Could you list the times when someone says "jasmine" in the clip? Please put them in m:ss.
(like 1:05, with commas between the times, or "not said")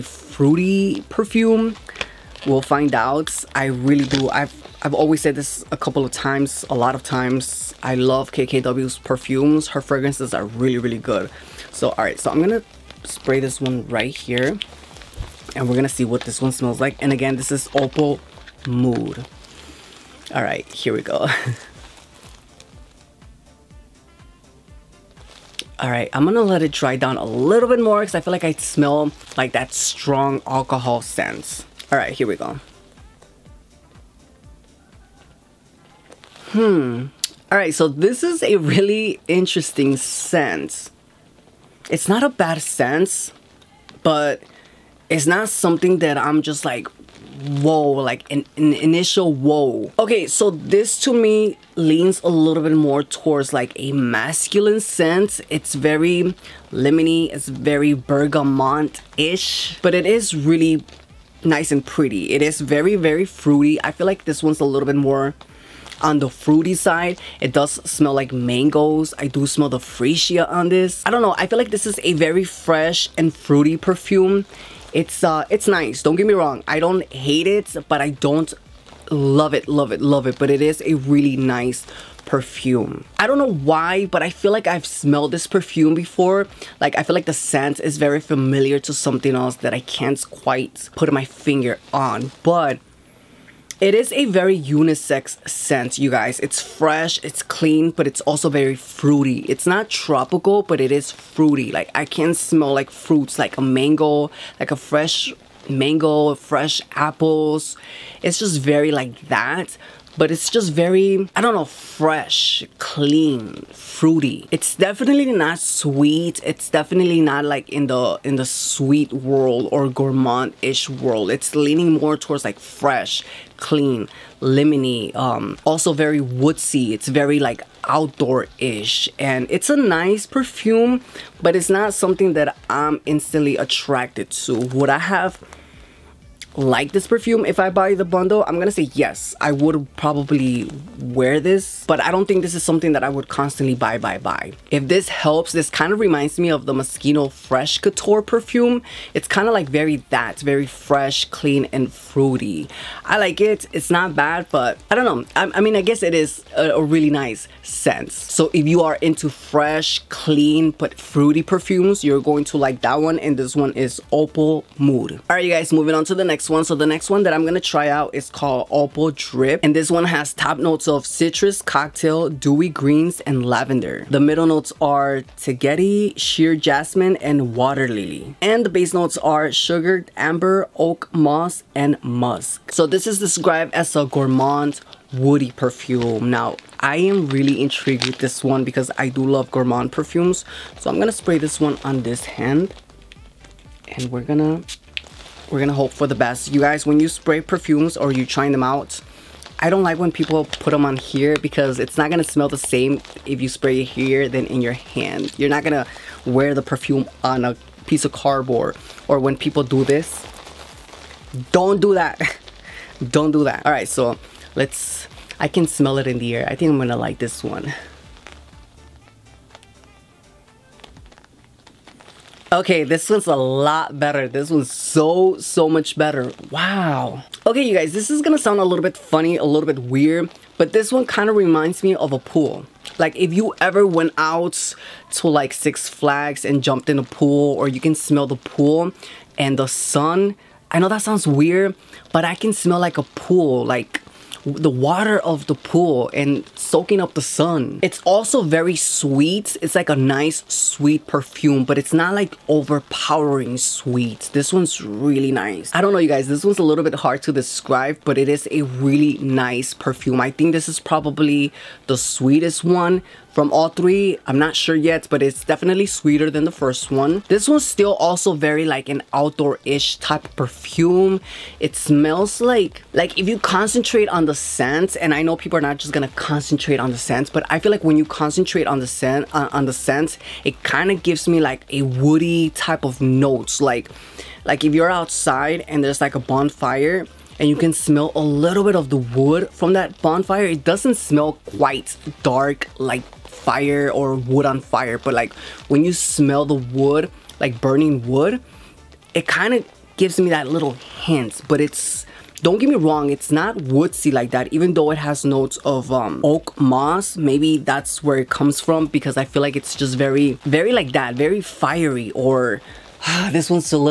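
2:56.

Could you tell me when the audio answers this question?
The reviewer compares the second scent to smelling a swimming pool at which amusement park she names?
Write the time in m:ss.
3:55.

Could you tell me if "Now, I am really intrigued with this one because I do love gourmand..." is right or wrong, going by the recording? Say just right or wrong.
right.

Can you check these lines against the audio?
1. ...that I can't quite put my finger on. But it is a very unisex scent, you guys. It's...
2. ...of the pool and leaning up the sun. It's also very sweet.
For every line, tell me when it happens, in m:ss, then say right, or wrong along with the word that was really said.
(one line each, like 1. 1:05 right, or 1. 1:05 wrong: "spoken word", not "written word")
1. 1:29 right
2. 4:05 wrong: "soaking", not "leaning".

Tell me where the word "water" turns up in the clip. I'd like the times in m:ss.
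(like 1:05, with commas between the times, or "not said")
2:57, 4:04.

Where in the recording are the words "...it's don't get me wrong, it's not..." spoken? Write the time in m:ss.
5:01.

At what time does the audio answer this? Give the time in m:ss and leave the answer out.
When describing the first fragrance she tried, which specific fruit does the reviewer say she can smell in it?
1:08.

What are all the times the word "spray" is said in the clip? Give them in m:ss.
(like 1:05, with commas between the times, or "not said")
0:13, 3:11, 3:17, 3:23.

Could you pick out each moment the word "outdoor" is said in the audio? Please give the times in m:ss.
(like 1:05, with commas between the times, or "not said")
2:07, 4:29.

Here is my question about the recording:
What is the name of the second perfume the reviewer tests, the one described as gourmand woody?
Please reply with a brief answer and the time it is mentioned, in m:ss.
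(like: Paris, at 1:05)
Opal Drip, at 2:48.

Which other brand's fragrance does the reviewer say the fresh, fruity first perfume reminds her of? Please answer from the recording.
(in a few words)
Moschino Fresh Couture.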